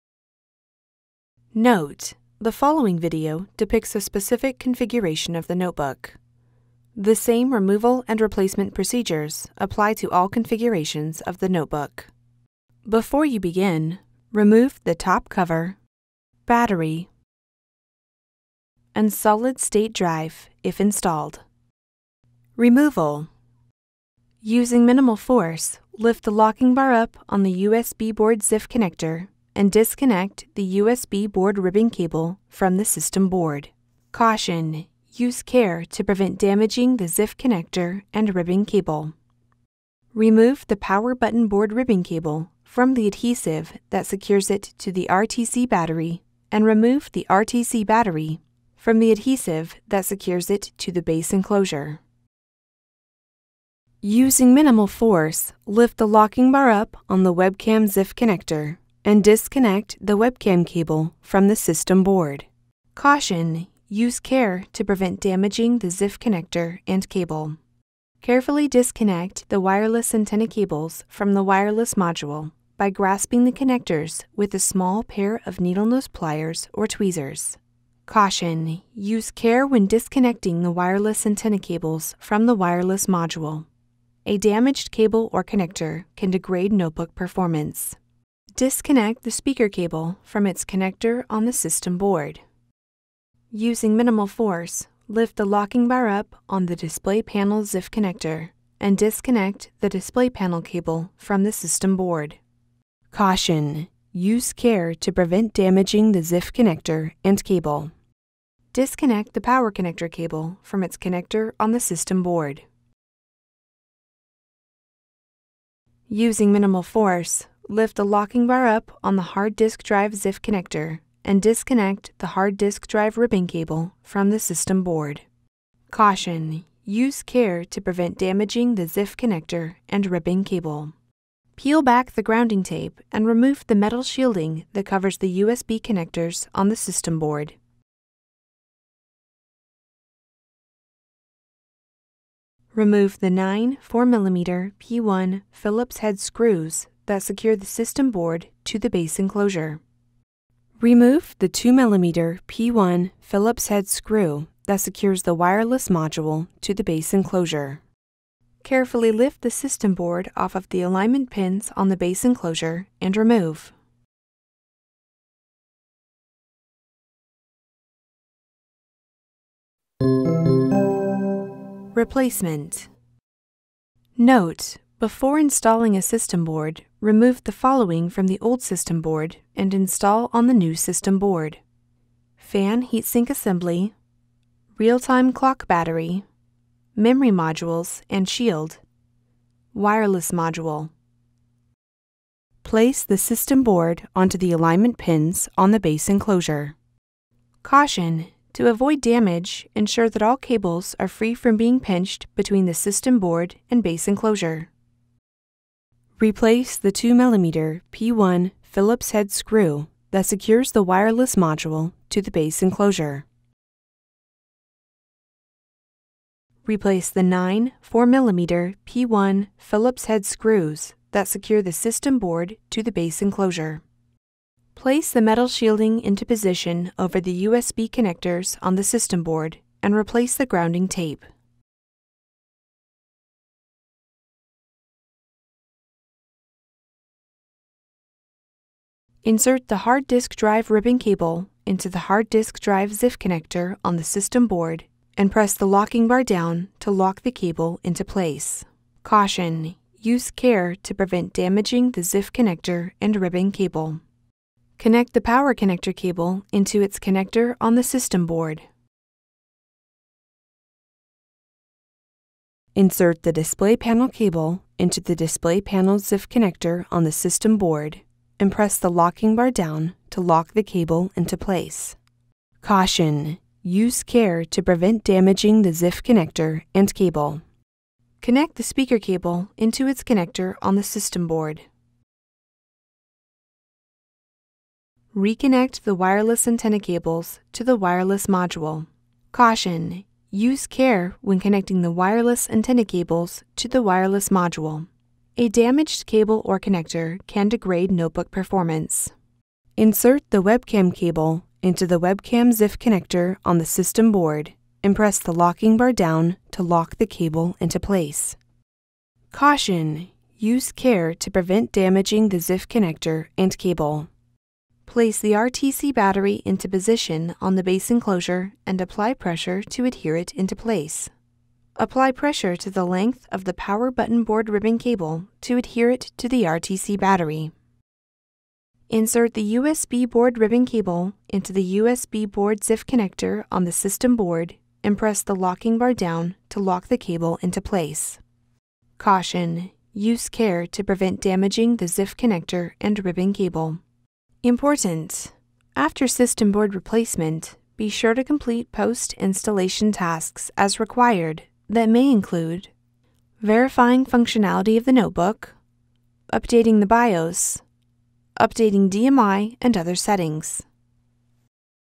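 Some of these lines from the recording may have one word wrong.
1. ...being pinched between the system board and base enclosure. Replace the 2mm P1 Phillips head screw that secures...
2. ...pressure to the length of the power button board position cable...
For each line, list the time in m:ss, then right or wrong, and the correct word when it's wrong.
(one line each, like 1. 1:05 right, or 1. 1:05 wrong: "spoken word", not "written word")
1. 3:21 right
2. 5:22 wrong: "ribbon", not "position".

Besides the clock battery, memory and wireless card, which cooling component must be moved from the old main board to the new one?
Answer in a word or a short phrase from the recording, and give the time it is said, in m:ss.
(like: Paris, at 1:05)
fan heatsink assembly, at 3:02.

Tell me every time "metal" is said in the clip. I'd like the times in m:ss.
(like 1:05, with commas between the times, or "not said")
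2:13, 3:45.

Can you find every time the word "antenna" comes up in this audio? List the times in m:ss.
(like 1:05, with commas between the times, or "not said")
1:10, 1:21, 4:46, 4:52.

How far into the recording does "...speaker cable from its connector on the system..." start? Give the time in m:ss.
1:29.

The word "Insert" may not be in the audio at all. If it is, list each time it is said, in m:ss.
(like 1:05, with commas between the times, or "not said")
3:59, 4:22, 4:59, 5:28.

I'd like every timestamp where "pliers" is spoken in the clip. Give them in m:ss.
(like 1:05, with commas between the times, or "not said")
1:16.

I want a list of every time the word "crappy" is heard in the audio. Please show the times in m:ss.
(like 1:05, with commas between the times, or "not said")
not said.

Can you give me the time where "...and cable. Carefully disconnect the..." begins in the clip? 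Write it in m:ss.
1:06.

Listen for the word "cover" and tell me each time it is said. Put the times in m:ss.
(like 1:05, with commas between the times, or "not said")
0:15, 2:14.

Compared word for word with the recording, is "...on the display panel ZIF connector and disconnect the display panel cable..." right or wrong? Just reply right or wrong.
right.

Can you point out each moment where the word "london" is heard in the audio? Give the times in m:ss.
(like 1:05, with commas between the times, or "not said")
not said.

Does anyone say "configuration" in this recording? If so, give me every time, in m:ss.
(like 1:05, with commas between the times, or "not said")
0:04, 0:10.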